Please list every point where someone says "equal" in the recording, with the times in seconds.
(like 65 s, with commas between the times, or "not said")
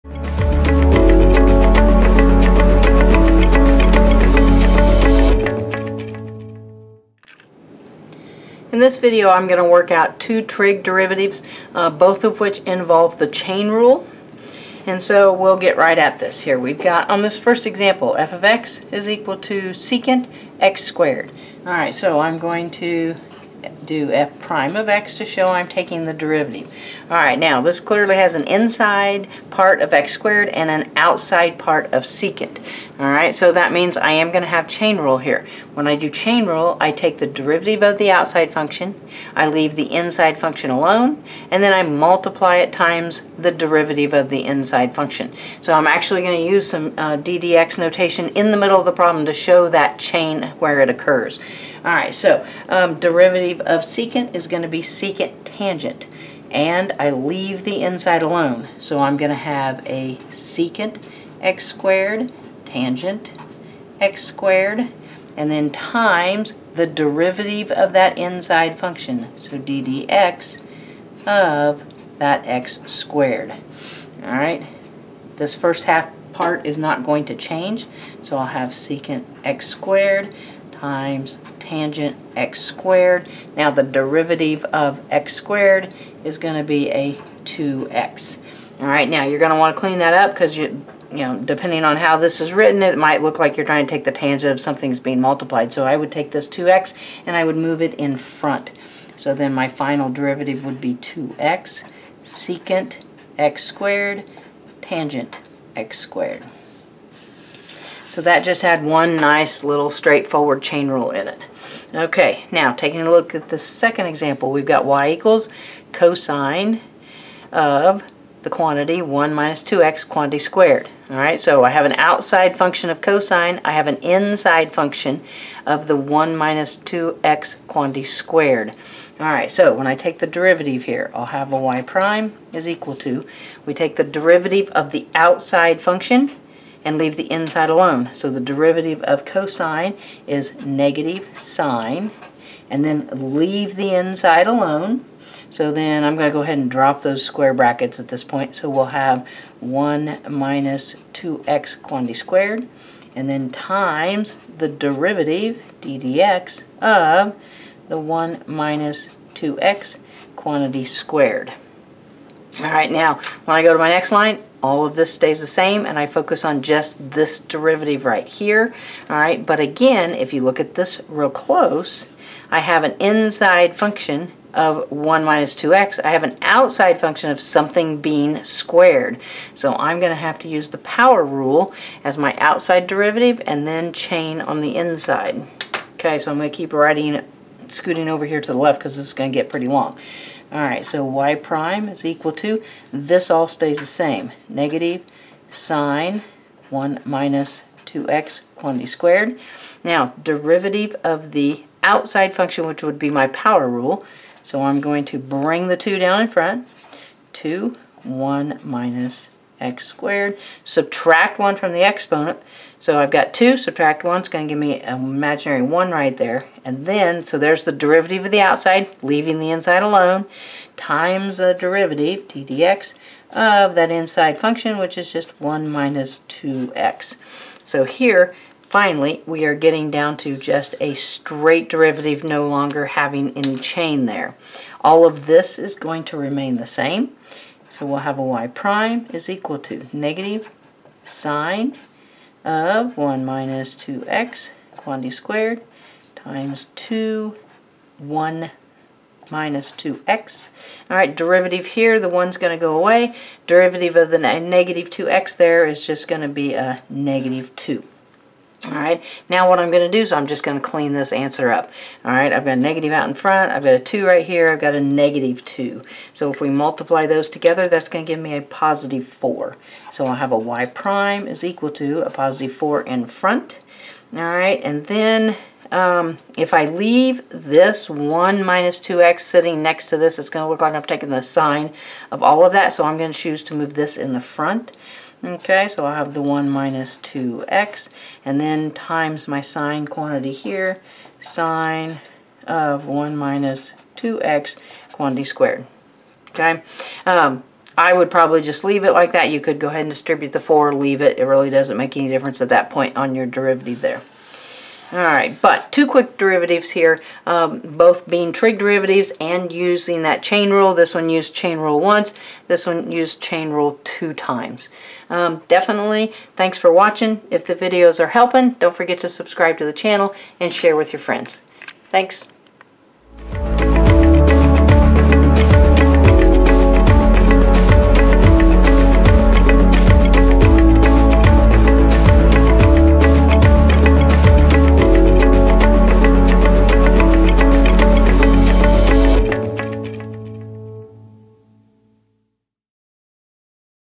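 19 s, 115 s, 132 s, 192 s, 239 s, 271 s.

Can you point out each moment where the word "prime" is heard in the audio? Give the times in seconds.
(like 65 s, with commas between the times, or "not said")
24 s, 131 s, 191 s, 238 s, 270 s.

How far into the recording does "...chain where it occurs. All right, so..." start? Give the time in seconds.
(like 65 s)
49 s.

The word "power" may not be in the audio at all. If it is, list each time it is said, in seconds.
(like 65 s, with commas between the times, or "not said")
180 s, 203 s.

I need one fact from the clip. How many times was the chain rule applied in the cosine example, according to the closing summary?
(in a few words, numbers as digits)
2.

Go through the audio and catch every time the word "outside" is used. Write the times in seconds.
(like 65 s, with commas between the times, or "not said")
30 s, 38 s, 121 s, 135 s, 176 s, 182 s, 201 s, 218 s.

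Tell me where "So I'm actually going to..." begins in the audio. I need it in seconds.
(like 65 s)
45 s.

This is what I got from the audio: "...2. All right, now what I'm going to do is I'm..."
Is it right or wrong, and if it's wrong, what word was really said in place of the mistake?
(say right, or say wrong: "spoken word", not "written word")
right.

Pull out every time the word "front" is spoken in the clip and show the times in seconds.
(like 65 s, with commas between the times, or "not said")
98 s, 206 s, 263 s, 273 s, 284 s.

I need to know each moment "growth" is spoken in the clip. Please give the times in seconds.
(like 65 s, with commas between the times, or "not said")
not said.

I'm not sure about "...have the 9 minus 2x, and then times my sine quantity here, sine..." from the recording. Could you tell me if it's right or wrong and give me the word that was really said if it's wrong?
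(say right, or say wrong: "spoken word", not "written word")
wrong: "1", not "9".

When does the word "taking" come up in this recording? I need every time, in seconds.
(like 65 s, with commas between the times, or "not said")
25 s, 112 s, 280 s.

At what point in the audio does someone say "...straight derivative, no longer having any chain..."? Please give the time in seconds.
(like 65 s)
230 s.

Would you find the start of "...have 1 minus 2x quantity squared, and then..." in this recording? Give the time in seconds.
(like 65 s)
148 s.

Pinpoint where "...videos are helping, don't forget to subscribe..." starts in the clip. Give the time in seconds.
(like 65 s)
317 s.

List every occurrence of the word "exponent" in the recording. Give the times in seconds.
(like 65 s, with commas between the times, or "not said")
211 s.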